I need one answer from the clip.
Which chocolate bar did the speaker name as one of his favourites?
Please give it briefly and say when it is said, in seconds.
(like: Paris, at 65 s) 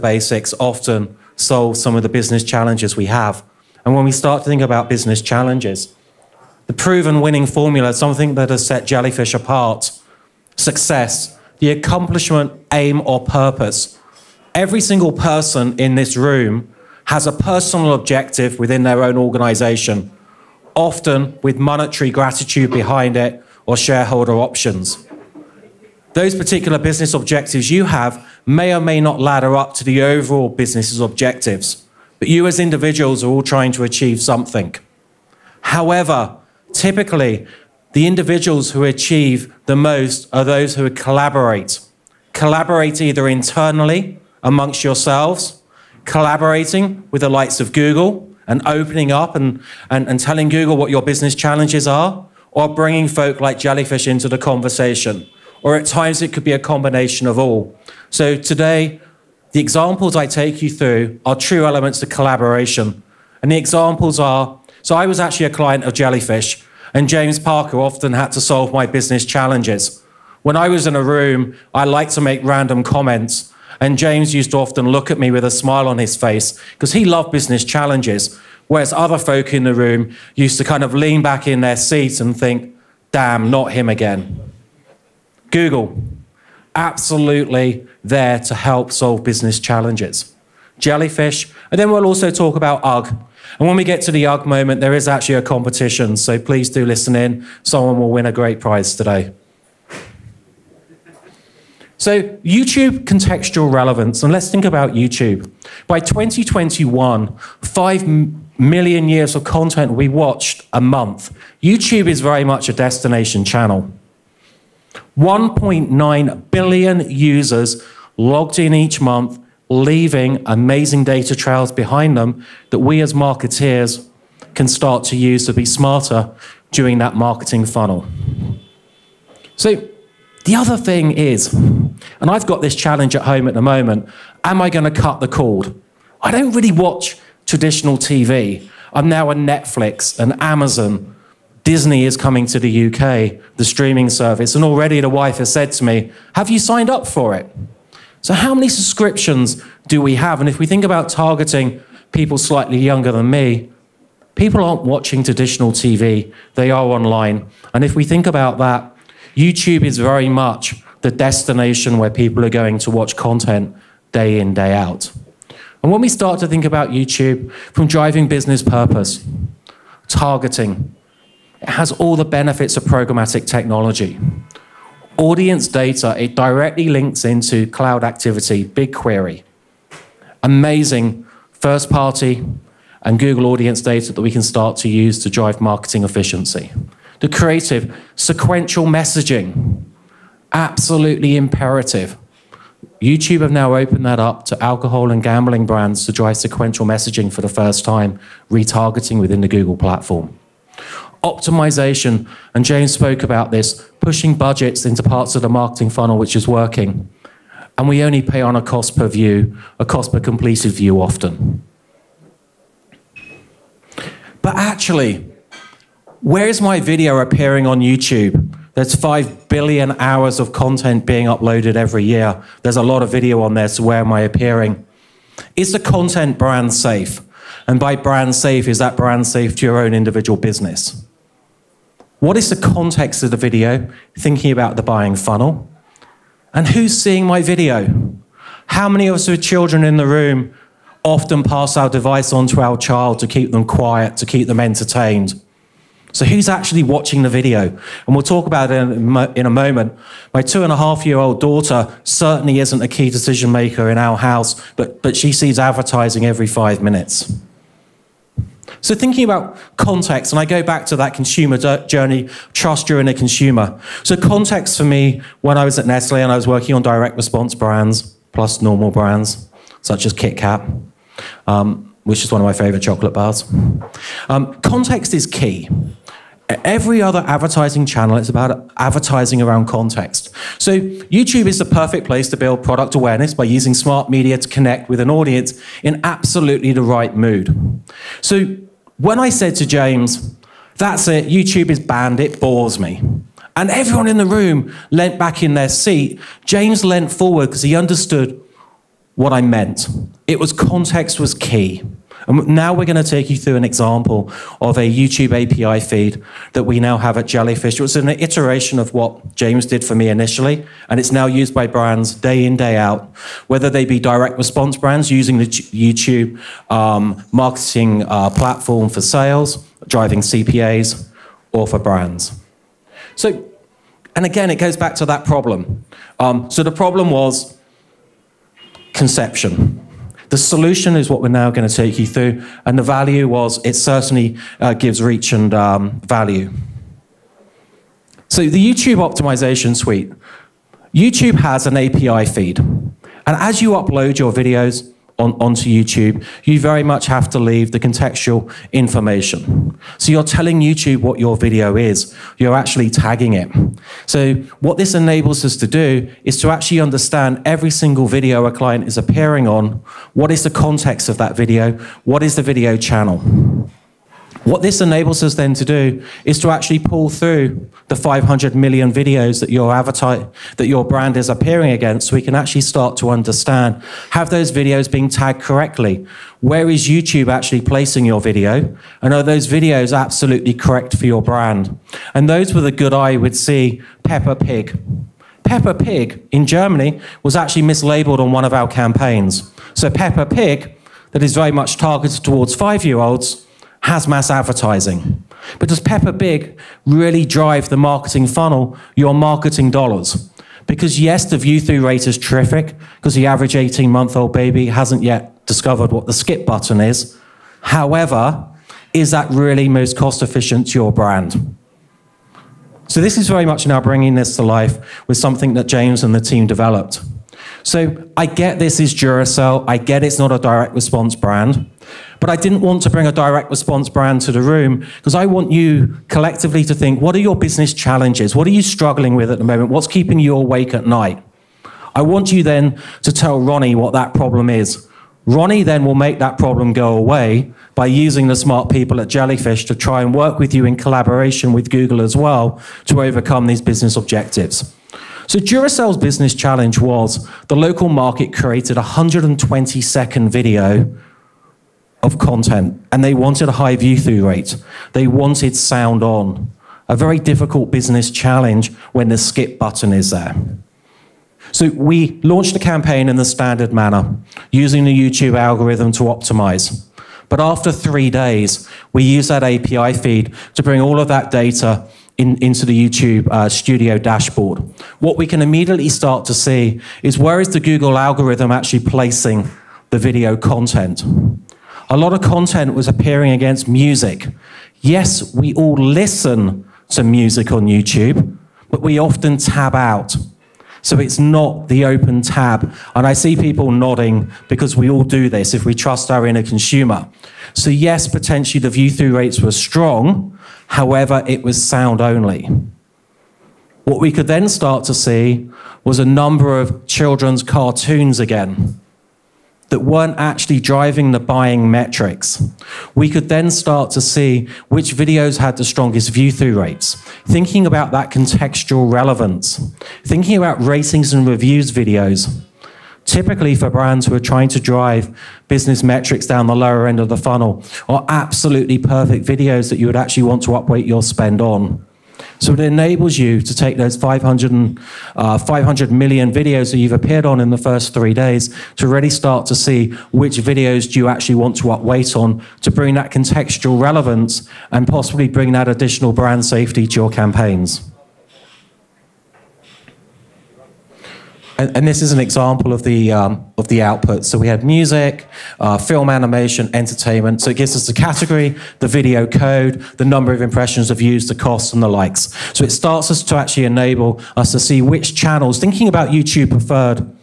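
Kit Kat, at 270 s.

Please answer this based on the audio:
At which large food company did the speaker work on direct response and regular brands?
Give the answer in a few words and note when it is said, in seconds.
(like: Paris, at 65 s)
Nestle, at 265 s.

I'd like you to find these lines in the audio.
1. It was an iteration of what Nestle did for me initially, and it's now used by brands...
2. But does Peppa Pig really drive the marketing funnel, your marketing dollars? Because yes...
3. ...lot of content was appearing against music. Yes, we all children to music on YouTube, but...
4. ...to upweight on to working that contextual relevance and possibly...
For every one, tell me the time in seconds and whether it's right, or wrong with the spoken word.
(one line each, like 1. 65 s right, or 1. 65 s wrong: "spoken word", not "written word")
1. 307 s wrong: "James", not "Nestle"
2. 395 s right
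3. 481 s wrong: "listen", not "children"
4. 541 s wrong: "bring", not "working".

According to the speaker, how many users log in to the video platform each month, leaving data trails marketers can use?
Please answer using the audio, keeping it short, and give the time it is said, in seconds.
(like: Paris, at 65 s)
1.9 billion, at 115 s.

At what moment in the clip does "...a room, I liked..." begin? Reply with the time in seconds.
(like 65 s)
70 s.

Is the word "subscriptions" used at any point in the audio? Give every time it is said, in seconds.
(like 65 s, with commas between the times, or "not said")
148 s.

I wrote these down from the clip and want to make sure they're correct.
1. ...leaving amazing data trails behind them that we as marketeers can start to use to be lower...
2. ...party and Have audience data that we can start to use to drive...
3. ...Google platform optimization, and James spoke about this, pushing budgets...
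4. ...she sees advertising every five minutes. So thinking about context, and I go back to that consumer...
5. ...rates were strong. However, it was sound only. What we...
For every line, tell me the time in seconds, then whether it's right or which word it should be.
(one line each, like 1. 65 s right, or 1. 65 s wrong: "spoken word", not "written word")
1. 119 s wrong: "smarter", not "lower"
2. 181 s wrong: "Google", not "Have"
3. 199 s right
4. 255 s right
5. 499 s right.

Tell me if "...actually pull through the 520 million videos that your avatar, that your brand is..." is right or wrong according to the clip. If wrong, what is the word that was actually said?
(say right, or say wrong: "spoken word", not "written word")
wrong: "500", not "520".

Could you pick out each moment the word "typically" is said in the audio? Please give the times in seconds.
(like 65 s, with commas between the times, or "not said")
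36 s, 523 s.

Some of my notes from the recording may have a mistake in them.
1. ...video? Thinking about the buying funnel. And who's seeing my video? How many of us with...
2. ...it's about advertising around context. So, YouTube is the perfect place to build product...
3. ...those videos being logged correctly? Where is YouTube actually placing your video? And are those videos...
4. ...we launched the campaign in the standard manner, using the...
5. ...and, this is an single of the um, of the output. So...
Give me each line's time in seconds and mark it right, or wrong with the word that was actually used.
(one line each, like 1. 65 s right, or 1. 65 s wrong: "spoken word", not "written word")
1. 233 s right
2. 278 s right
3. 374 s wrong: "tagged", not "logged"
4. 461 s right
5. 551 s wrong: "example", not "single".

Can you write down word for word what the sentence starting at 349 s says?
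So you're telling YouTube what your video is, you're actually tagging it.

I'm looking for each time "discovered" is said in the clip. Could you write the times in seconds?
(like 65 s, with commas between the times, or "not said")
405 s.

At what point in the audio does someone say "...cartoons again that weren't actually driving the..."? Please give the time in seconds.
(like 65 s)
507 s.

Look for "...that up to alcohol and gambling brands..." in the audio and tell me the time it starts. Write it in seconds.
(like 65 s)
194 s.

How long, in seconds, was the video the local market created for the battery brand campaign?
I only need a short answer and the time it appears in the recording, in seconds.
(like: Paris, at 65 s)
120, at 448 s.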